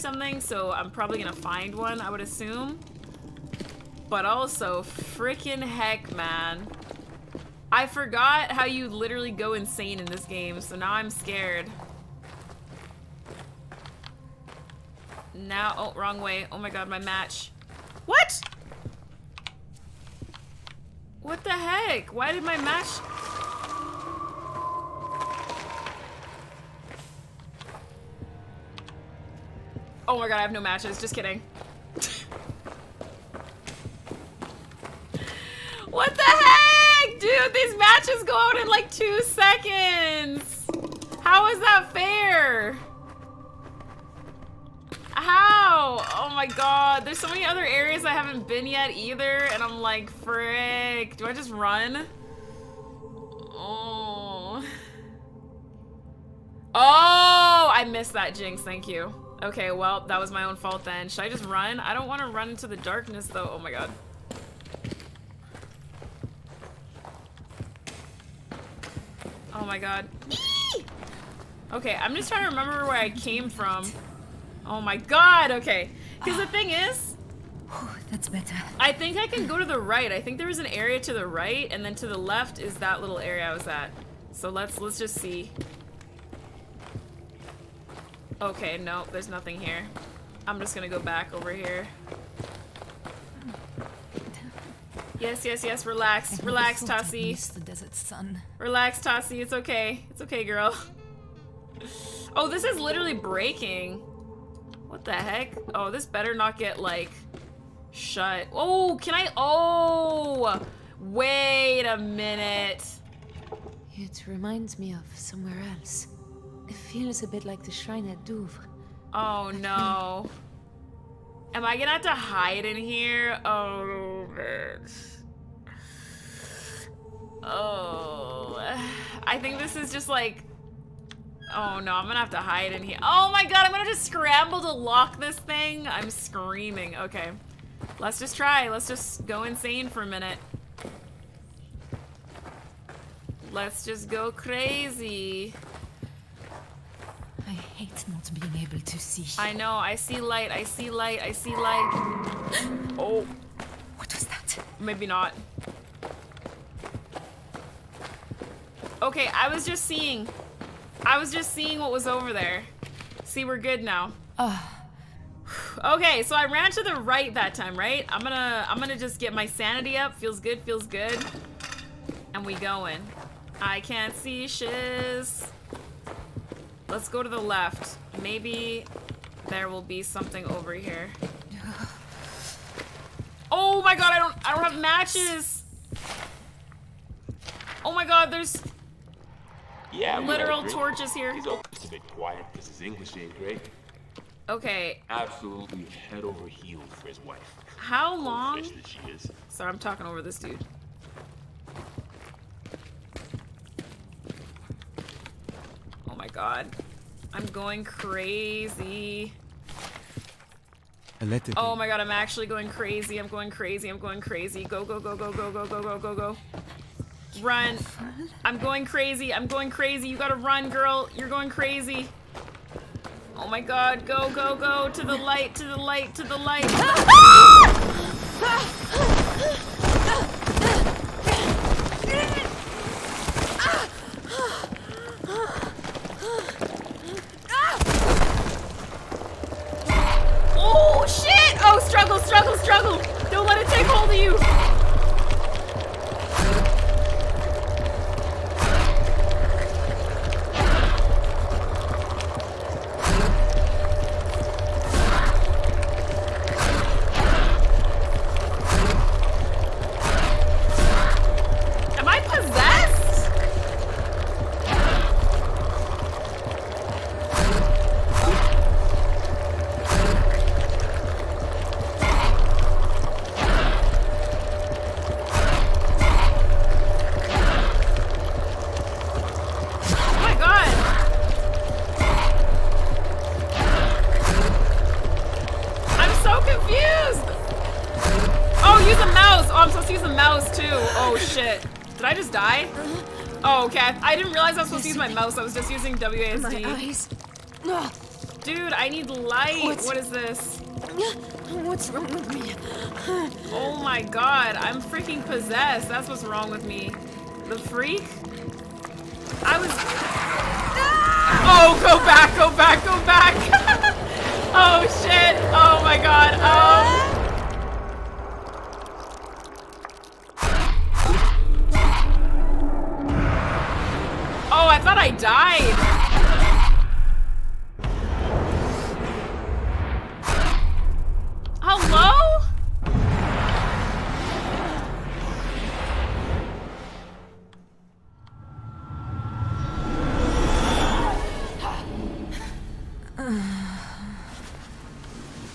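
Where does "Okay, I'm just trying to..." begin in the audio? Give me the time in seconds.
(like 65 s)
71 s.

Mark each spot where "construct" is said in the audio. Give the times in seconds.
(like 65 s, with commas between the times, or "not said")
not said.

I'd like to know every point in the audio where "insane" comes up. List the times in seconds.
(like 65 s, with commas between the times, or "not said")
9 s, 139 s.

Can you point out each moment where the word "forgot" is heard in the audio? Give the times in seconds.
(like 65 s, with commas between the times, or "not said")
7 s.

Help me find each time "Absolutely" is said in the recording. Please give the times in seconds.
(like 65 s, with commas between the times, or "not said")
195 s.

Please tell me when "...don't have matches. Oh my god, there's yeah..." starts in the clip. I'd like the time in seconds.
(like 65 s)
184 s.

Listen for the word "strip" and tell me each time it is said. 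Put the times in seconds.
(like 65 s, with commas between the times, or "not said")
not said.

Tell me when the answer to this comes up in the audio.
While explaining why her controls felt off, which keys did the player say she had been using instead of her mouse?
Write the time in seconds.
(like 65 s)
295 s.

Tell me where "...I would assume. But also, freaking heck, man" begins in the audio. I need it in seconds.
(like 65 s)
1 s.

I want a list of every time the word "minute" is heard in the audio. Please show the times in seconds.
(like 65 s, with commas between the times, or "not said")
111 s, 140 s.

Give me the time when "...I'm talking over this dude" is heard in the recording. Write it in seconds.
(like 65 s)
199 s.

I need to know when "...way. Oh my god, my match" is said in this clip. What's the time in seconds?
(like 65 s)
16 s.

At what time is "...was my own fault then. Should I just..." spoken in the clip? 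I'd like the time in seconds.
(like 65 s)
60 s.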